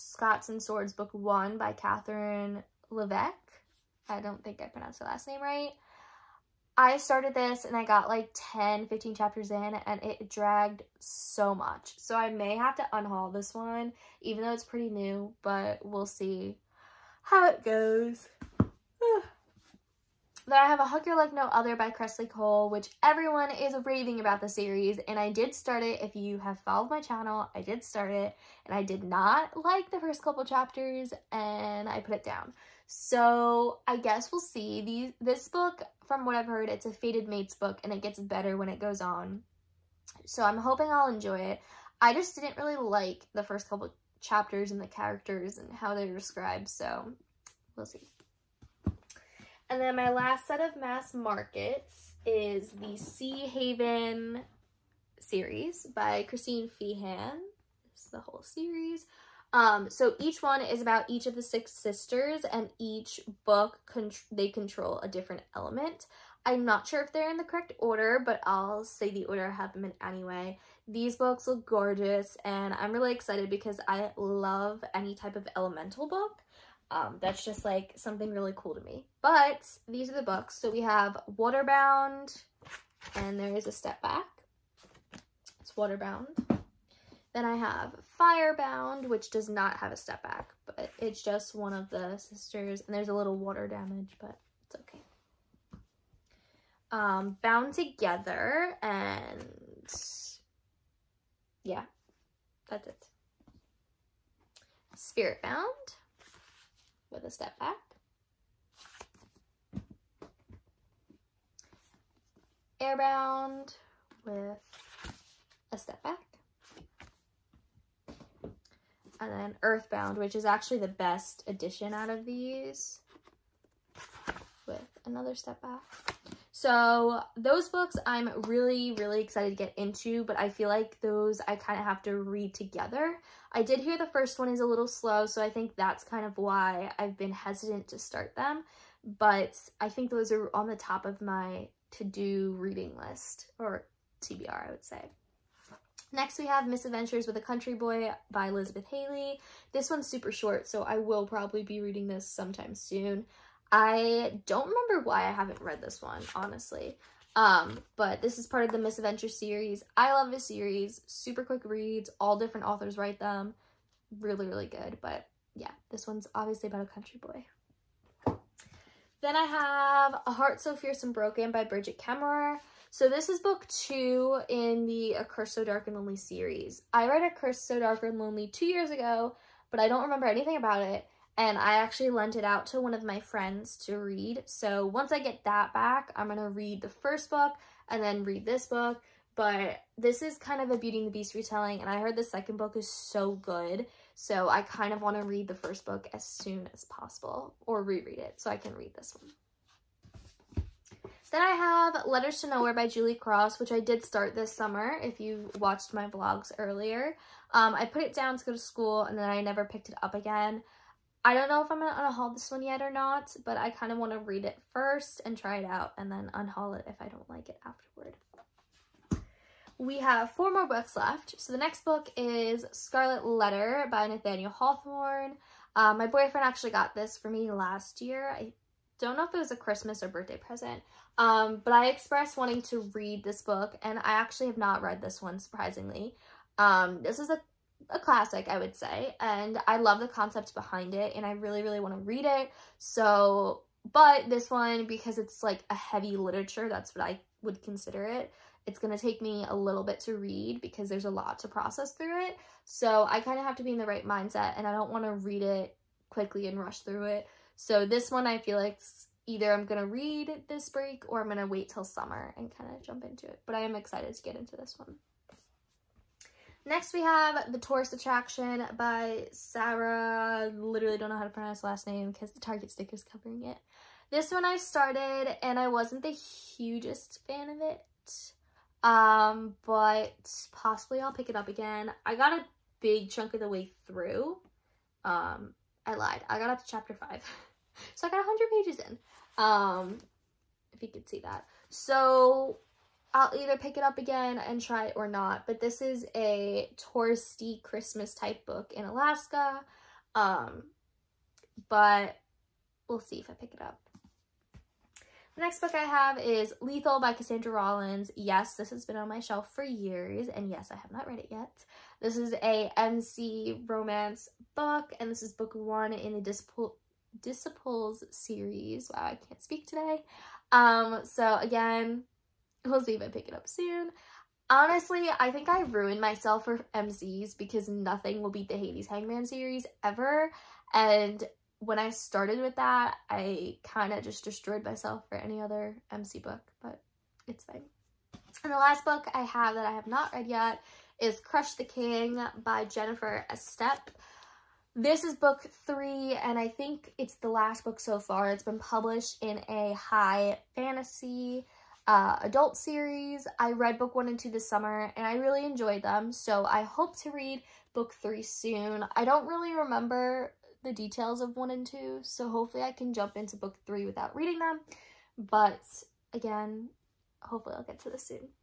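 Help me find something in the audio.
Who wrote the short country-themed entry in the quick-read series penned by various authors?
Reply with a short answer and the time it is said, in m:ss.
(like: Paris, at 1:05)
Elizabeth Hayley, at 2:28.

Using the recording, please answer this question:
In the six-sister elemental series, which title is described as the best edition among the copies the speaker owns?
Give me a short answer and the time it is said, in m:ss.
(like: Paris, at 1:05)
Earthbound, at 1:59.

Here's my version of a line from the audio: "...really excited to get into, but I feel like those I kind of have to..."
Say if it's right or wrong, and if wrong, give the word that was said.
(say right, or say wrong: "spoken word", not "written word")
right.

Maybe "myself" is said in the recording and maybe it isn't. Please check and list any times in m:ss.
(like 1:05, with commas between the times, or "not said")
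5:25, 5:34.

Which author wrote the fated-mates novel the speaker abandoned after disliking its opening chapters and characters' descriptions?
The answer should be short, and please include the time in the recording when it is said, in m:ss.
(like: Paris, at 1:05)
Kresley Cole, at 0:21.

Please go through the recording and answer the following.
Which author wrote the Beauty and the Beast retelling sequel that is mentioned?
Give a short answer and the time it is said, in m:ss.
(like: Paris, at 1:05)
Brigid Kemmerer, at 2:51.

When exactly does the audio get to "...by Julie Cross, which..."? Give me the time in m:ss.
3:22.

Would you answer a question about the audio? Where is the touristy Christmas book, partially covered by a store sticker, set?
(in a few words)
Alaska.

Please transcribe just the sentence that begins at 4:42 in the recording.
I got a big chunk of the way through, um, I lied.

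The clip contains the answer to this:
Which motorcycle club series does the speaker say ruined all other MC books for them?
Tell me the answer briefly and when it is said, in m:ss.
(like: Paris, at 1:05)
Hades Hangmen, at 5:28.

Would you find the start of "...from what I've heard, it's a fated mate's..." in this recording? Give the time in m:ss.
0:36.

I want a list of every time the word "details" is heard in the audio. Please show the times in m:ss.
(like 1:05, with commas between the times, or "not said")
6:00.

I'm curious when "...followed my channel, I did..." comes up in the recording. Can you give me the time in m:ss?
0:26.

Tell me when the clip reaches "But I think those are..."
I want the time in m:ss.
2:19.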